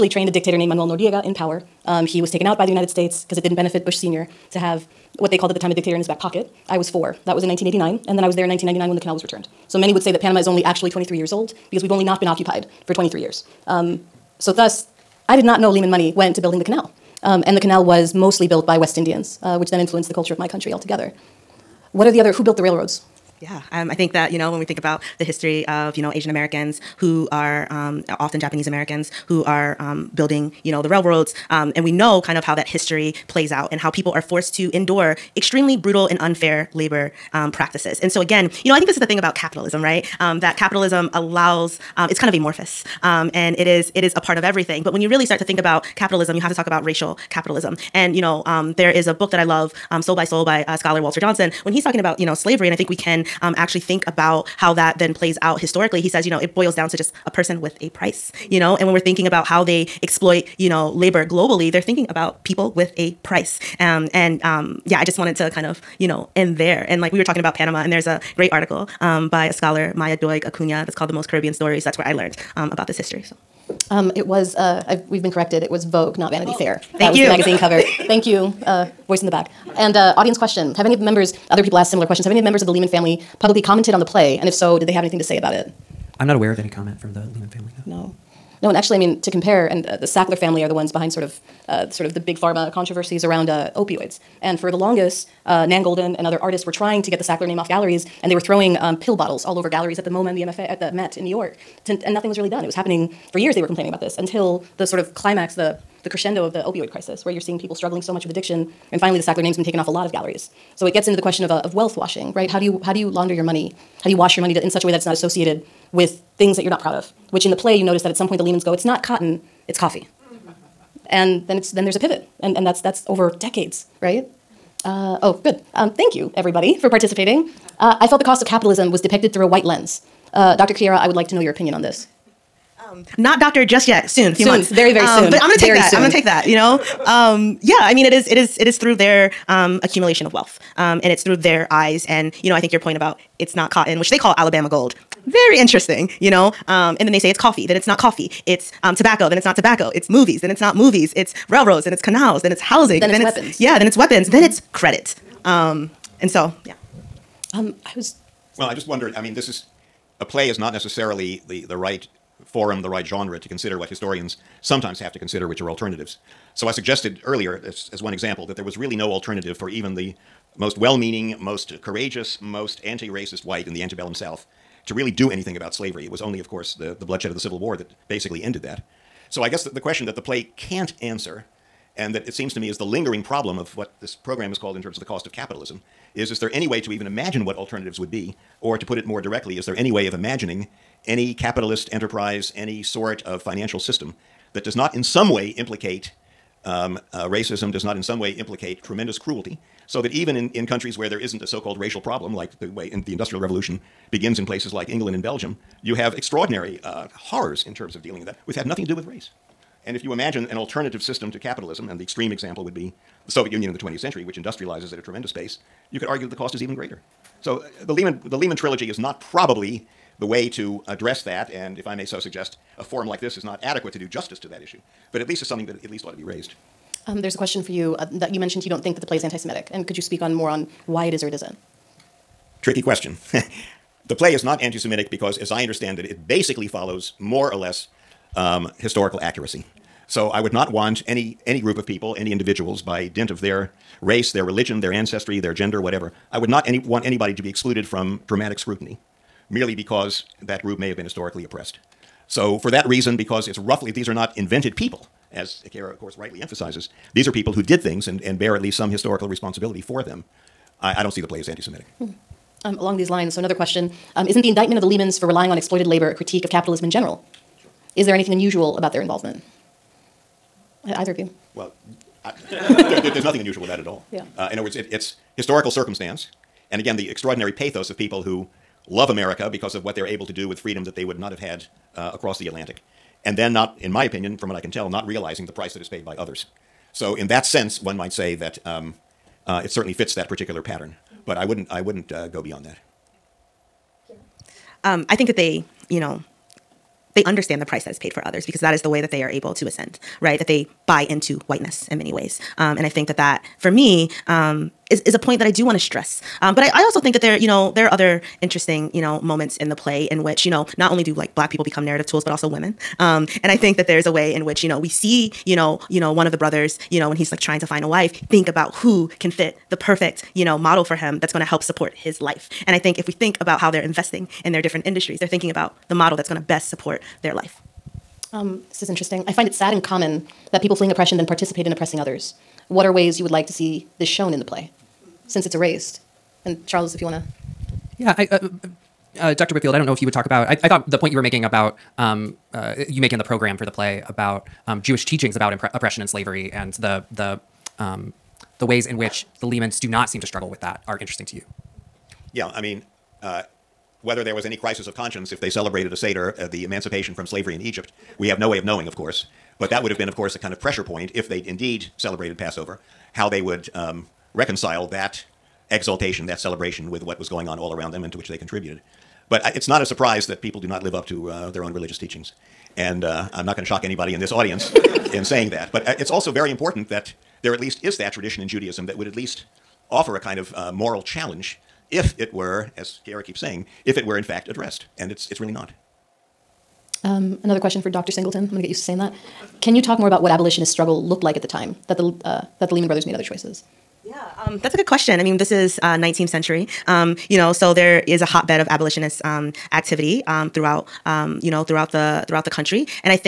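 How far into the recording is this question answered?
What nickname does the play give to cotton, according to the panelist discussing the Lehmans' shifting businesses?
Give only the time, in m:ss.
2:24.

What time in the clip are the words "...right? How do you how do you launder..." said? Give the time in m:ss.
1:52.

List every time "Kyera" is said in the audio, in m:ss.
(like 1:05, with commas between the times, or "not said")
2:10, 6:23.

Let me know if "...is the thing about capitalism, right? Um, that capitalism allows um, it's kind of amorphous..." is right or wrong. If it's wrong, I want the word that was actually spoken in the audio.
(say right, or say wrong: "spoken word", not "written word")
right.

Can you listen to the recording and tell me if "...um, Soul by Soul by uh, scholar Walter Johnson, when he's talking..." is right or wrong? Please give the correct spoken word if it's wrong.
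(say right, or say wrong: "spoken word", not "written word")
right.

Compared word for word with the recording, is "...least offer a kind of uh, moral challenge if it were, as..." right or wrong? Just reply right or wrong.
right.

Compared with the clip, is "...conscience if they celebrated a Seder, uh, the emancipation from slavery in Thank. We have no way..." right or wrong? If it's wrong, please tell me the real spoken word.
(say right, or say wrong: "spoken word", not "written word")
wrong: "Egypt", not "Thank".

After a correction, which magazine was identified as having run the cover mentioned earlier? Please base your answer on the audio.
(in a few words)
Vogue.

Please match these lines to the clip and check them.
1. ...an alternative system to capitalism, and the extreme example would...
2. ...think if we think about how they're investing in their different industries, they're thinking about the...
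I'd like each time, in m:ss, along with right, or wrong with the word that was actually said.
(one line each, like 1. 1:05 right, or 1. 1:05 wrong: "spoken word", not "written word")
1. 3:30 right
2. 5:22 right.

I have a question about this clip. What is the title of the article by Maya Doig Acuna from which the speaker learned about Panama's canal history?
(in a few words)
The Most Caribbean Stories.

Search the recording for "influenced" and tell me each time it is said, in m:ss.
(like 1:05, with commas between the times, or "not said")
0:19.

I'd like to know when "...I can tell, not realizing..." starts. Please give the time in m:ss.
4:44.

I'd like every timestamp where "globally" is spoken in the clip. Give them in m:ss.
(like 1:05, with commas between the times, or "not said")
1:01.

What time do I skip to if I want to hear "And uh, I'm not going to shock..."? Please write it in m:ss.
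6:12.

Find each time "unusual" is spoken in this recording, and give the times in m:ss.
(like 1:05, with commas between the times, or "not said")
4:28, 4:33.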